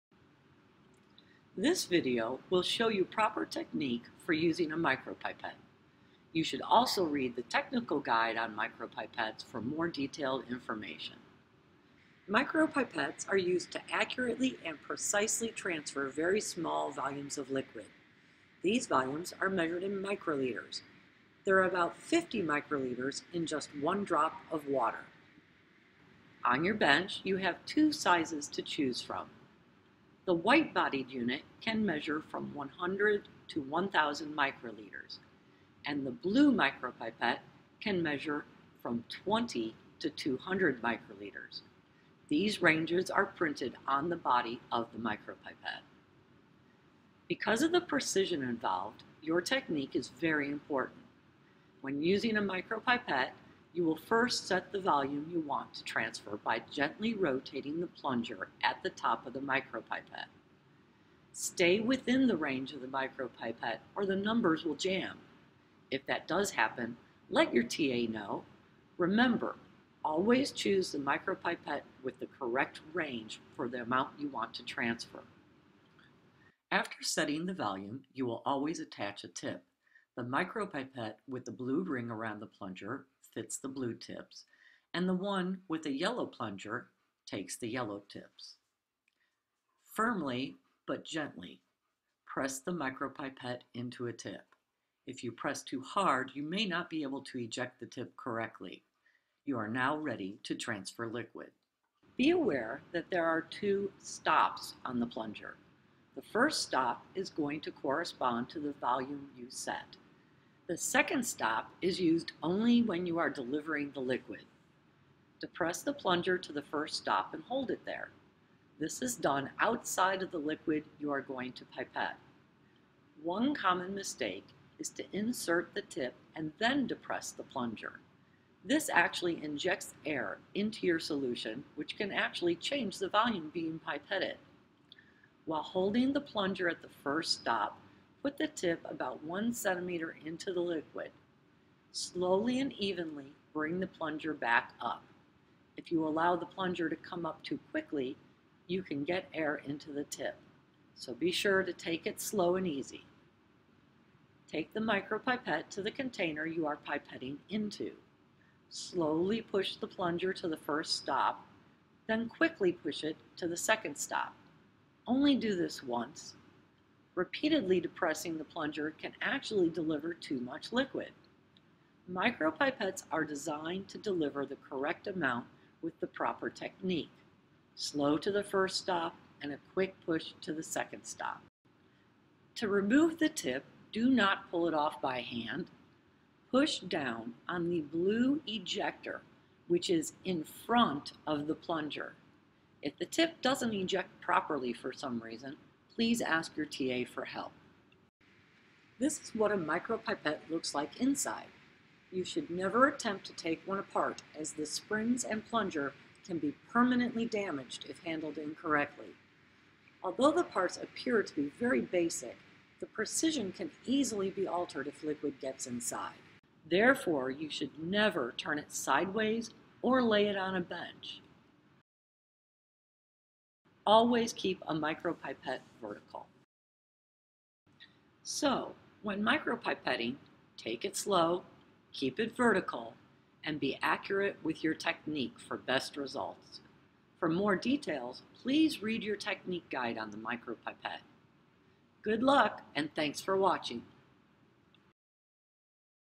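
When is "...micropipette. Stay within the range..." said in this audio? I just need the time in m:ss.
0:59.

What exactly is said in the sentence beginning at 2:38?
Slowly push the plunger to the first stop, then quickly push it to the second stop.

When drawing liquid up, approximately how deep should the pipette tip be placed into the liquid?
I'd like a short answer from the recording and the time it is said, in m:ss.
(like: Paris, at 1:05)
1 centimeter, at 2:19.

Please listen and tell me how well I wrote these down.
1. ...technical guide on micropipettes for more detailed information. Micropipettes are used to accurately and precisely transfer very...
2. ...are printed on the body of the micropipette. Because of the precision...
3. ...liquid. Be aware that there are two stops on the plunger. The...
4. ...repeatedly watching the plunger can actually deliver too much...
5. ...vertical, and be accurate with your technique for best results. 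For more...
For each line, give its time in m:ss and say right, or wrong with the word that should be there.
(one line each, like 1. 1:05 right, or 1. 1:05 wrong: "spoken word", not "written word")
1. 0:07 right
2. 0:43 right
3. 1:41 right
4. 2:47 wrong: "depressing", not "watching"
5. 3:52 right.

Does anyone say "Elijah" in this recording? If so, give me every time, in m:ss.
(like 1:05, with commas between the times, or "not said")
not said.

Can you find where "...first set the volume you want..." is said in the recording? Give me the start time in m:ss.
0:53.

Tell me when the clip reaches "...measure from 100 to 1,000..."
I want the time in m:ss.
0:31.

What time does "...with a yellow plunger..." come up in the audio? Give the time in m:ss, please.
1:25.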